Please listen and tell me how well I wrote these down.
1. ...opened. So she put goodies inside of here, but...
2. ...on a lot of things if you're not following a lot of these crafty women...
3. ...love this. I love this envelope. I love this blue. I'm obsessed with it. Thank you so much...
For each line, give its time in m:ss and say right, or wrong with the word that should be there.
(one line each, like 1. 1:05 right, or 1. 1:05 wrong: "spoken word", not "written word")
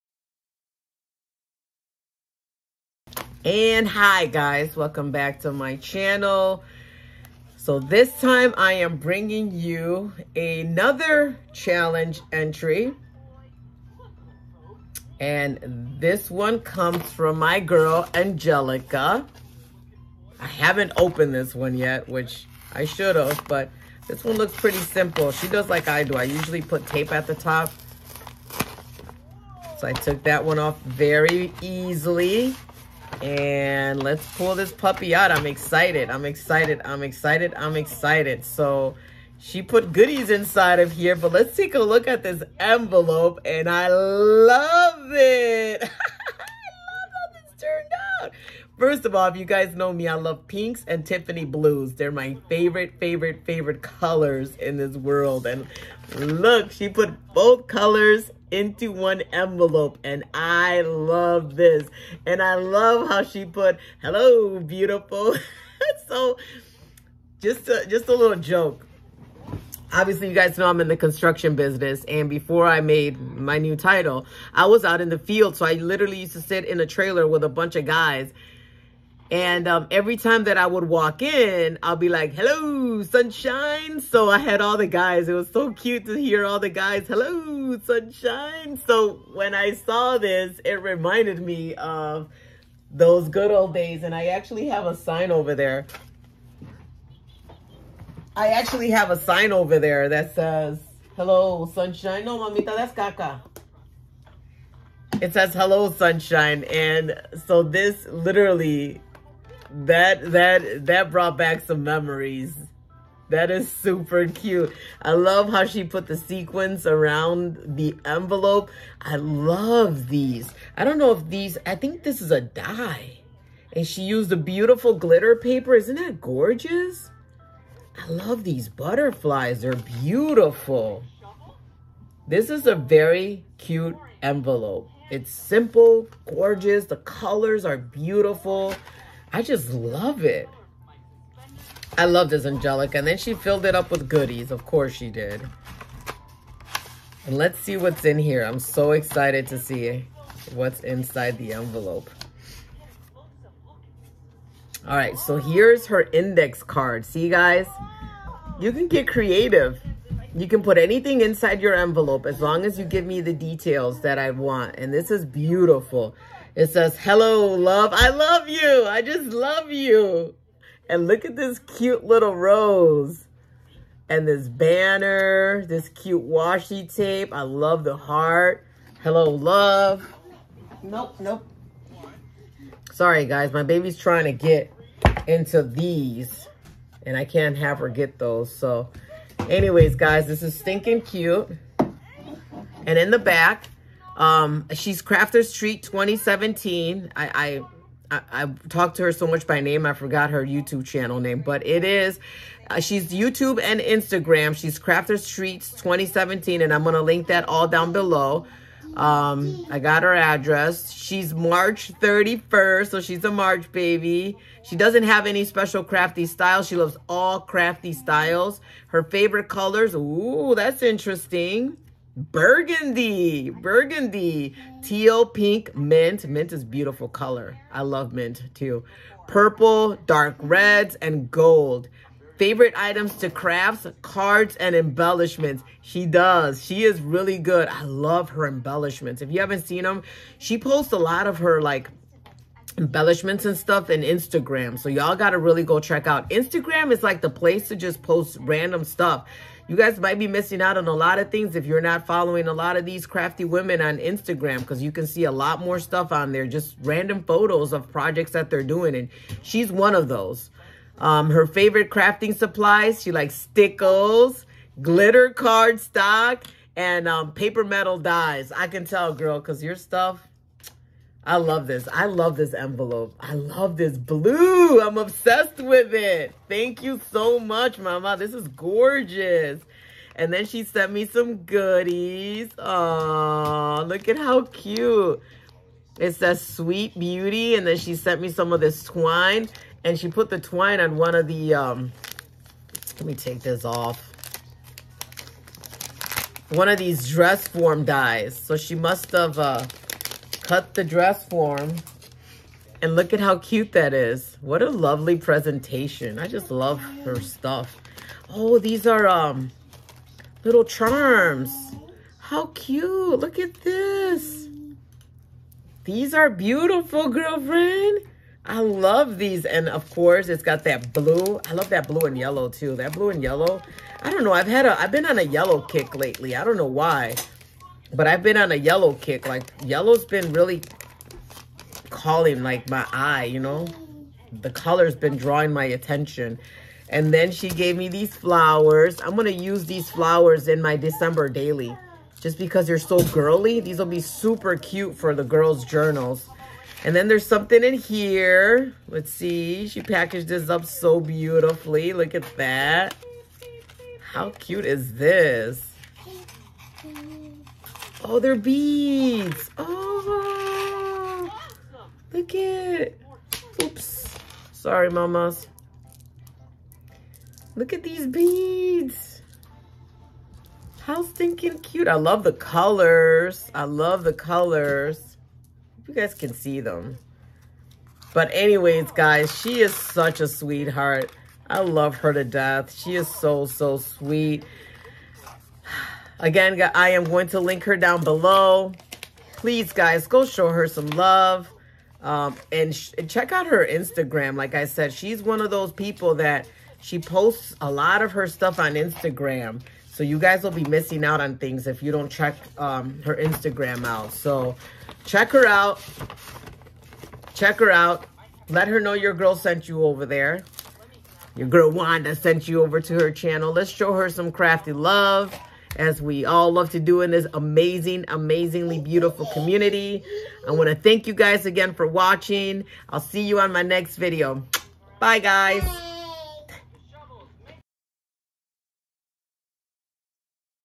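1. 0:37 wrong: "excited", not "opened"
2. 4:10 right
3. 4:31 right.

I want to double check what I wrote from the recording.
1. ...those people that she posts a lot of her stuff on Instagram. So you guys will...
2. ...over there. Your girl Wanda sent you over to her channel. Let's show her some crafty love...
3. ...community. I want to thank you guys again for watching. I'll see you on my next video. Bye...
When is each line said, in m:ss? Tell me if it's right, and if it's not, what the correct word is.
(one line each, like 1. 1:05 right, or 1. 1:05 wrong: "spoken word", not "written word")
1. 6:35 right
2. 6:49 right
3. 6:59 right.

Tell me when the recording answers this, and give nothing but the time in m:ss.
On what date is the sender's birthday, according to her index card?
3:31.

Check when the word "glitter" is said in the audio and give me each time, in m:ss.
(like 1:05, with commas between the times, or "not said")
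2:04, 4:24.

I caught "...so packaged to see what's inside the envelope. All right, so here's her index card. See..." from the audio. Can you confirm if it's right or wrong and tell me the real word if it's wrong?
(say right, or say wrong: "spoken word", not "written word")
wrong: "excited", not "packaged".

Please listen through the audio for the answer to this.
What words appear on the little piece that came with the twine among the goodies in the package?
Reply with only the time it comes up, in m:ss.
4:46.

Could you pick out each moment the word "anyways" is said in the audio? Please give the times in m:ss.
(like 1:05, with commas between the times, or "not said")
3:09, 6:18.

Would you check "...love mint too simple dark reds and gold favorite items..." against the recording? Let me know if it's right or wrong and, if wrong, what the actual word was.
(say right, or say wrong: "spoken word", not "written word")
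wrong: "purple", not "simple".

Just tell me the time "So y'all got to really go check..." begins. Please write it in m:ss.
4:04.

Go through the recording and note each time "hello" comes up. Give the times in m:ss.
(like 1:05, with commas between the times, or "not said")
1:04, 1:22, 1:27, 1:41, 1:45, 2:46, 2:59.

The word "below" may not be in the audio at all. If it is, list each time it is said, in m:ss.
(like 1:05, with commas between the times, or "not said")
3:27, 6:28.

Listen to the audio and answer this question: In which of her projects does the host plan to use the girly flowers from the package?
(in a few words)
December daily.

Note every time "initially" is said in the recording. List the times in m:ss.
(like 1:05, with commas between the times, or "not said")
not said.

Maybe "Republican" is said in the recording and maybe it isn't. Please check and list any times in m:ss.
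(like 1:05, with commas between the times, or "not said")
not said.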